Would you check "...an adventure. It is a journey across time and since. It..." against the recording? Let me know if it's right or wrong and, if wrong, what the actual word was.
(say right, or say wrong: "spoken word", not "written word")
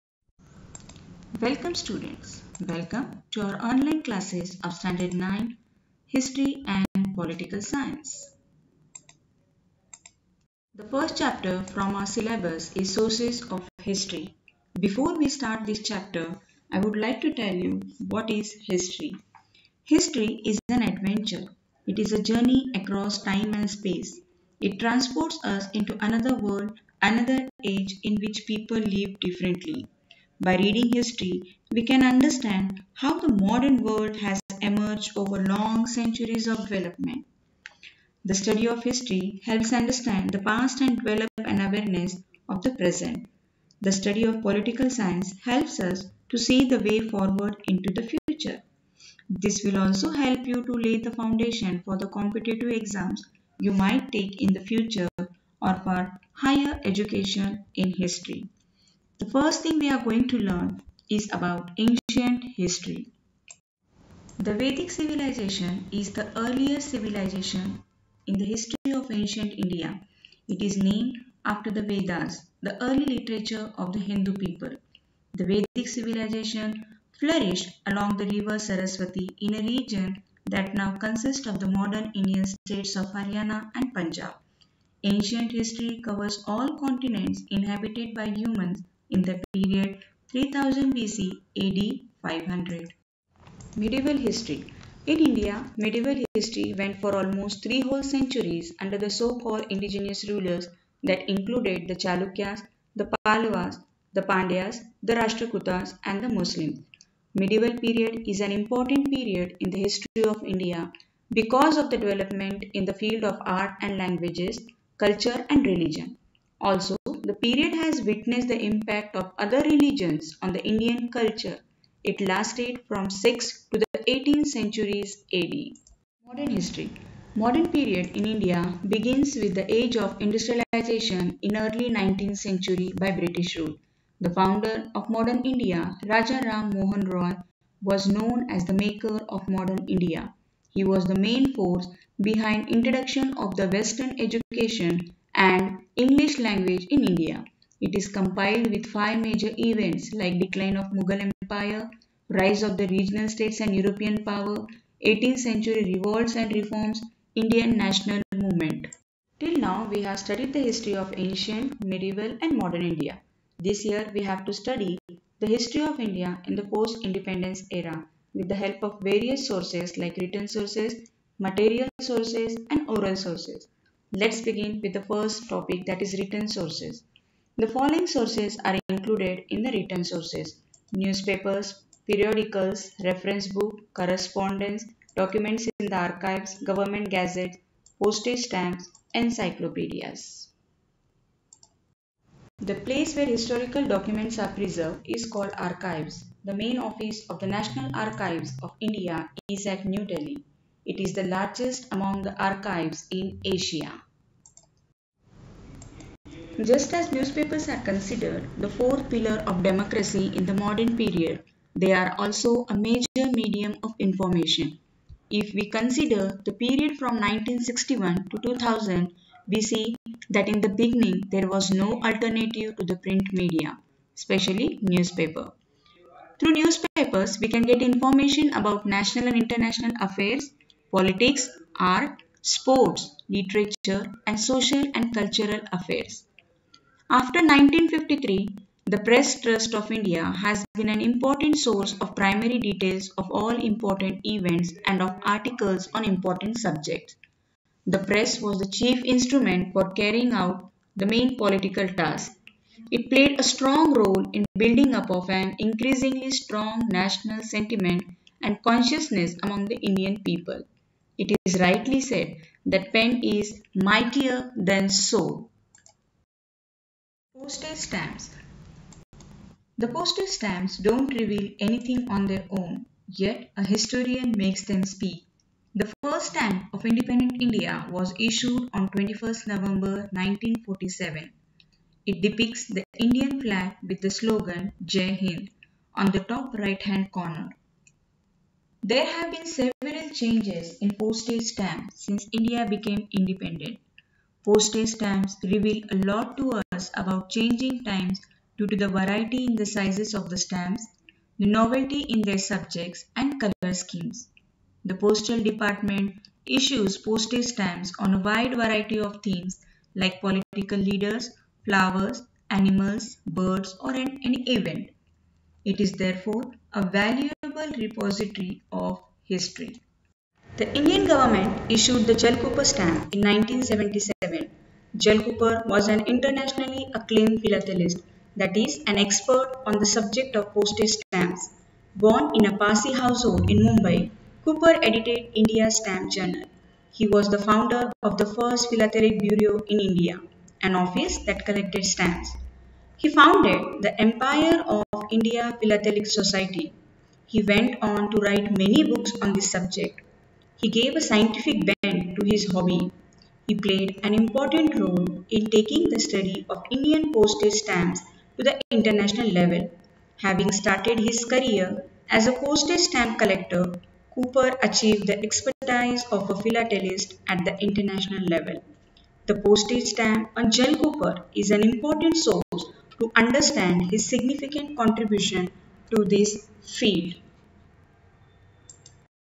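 wrong: "space", not "since".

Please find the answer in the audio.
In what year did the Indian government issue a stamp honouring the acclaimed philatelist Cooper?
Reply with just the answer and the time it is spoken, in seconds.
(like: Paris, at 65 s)
1977, at 323 s.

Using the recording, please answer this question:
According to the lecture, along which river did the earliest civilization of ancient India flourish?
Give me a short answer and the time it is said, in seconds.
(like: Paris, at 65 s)
Saraswati, at 78 s.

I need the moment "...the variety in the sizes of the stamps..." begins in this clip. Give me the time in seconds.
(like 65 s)
298 s.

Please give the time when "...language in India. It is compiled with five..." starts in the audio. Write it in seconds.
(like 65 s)
146 s.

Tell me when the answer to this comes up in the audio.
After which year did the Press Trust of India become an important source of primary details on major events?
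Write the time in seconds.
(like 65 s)
237 s.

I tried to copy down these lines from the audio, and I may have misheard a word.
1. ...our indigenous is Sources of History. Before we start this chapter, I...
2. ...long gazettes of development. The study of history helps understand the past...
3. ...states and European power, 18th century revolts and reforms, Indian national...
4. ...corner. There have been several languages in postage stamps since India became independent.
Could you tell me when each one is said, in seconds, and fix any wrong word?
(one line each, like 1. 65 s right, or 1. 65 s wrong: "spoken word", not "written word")
1. 11 s wrong: "syllabus", not "indigenous"
2. 35 s wrong: "centuries", not "gazettes"
3. 153 s right
4. 287 s wrong: "changes", not "languages".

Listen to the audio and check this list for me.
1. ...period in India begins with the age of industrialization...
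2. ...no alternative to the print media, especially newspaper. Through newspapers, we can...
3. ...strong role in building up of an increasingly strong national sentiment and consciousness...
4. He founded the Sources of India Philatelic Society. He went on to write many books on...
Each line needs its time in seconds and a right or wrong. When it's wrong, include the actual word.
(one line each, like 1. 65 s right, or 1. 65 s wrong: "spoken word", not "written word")
1. 127 s right
2. 221 s right
3. 253 s right
4. 343 s wrong: "Empire", not "Sources".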